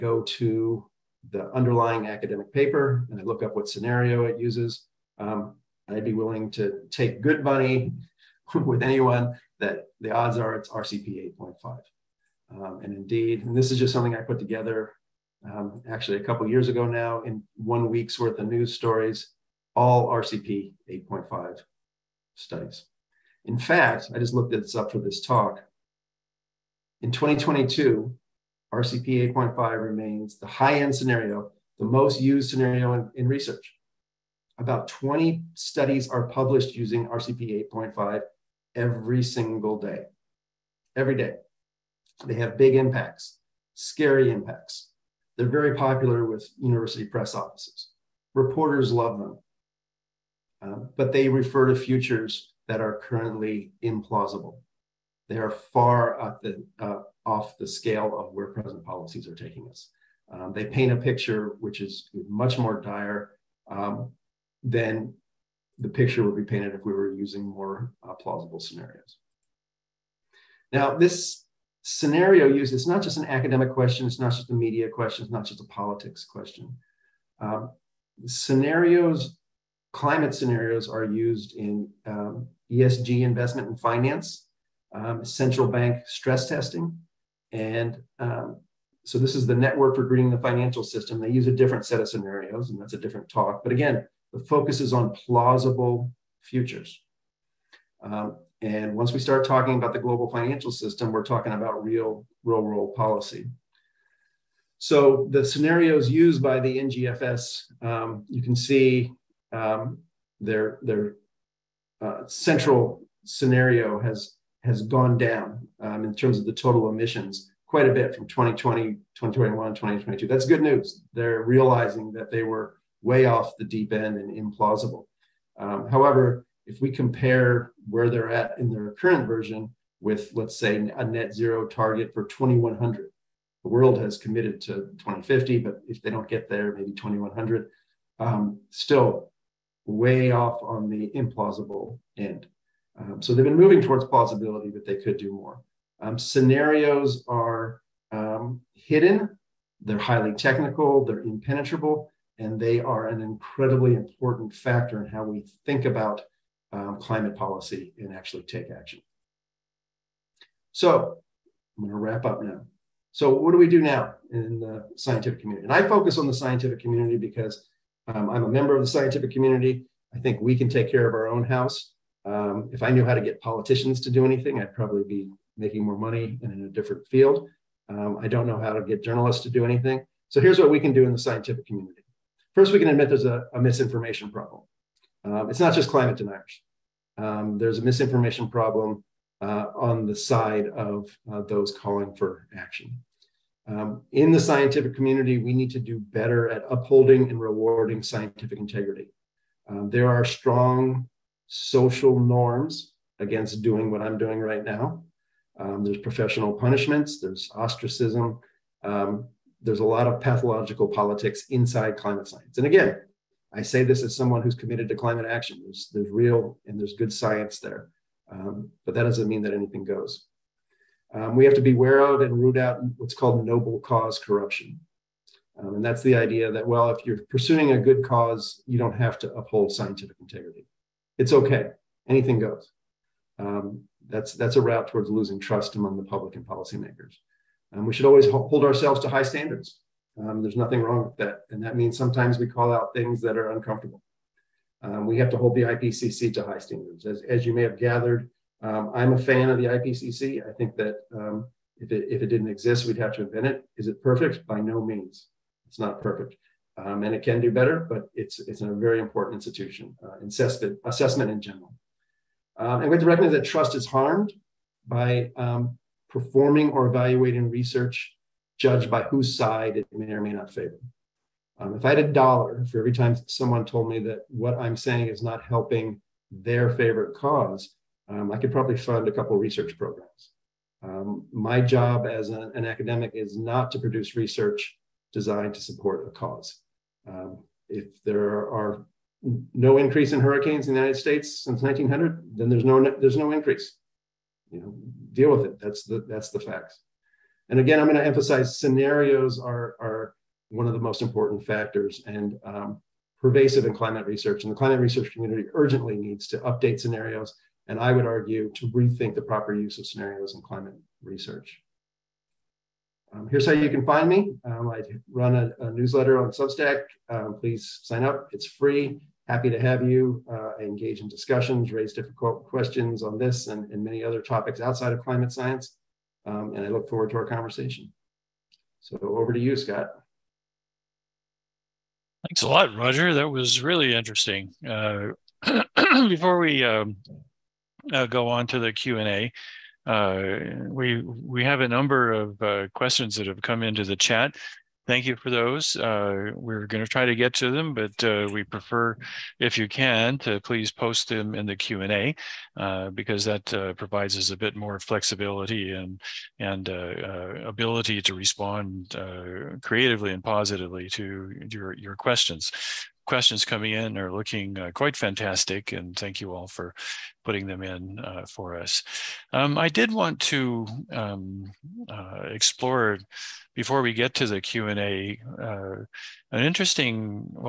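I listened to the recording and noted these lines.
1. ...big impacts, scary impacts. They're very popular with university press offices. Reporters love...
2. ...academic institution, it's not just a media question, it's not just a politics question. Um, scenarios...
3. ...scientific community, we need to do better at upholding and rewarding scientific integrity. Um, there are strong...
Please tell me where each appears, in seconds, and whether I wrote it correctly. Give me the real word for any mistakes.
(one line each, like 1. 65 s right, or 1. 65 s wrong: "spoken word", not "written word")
1. 42 s right
2. 73 s wrong: "question", not "institution"
3. 194 s right.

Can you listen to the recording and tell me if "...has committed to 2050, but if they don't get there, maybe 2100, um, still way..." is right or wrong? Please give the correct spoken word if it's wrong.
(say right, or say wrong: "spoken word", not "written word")
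right.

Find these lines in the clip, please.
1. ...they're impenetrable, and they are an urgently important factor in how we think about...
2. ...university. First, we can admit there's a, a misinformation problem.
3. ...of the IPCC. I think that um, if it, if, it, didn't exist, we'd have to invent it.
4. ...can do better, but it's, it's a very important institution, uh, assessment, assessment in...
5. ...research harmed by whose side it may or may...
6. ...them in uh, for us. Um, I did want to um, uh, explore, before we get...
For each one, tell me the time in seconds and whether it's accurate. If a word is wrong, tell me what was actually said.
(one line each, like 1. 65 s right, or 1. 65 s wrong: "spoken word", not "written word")
1. 151 s wrong: "incredibly", not "urgently"
2. 181 s wrong: "community", not "university"
3. 249 s right
4. 257 s right
5. 267 s wrong: "judged", not "harmed"
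6. 367 s right.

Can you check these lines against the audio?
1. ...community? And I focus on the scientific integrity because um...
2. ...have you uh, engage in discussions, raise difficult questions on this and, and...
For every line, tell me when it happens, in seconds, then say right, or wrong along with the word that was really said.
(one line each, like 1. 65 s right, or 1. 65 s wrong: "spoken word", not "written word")
1. 165 s wrong: "community", not "integrity"
2. 319 s right.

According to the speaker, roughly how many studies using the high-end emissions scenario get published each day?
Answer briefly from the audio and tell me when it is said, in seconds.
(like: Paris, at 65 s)
20, at 34 s.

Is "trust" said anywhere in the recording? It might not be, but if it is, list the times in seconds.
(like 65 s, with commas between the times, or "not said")
235 s, 263 s.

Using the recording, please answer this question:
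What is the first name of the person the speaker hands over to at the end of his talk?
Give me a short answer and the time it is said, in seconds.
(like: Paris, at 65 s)
Scott, at 329 s.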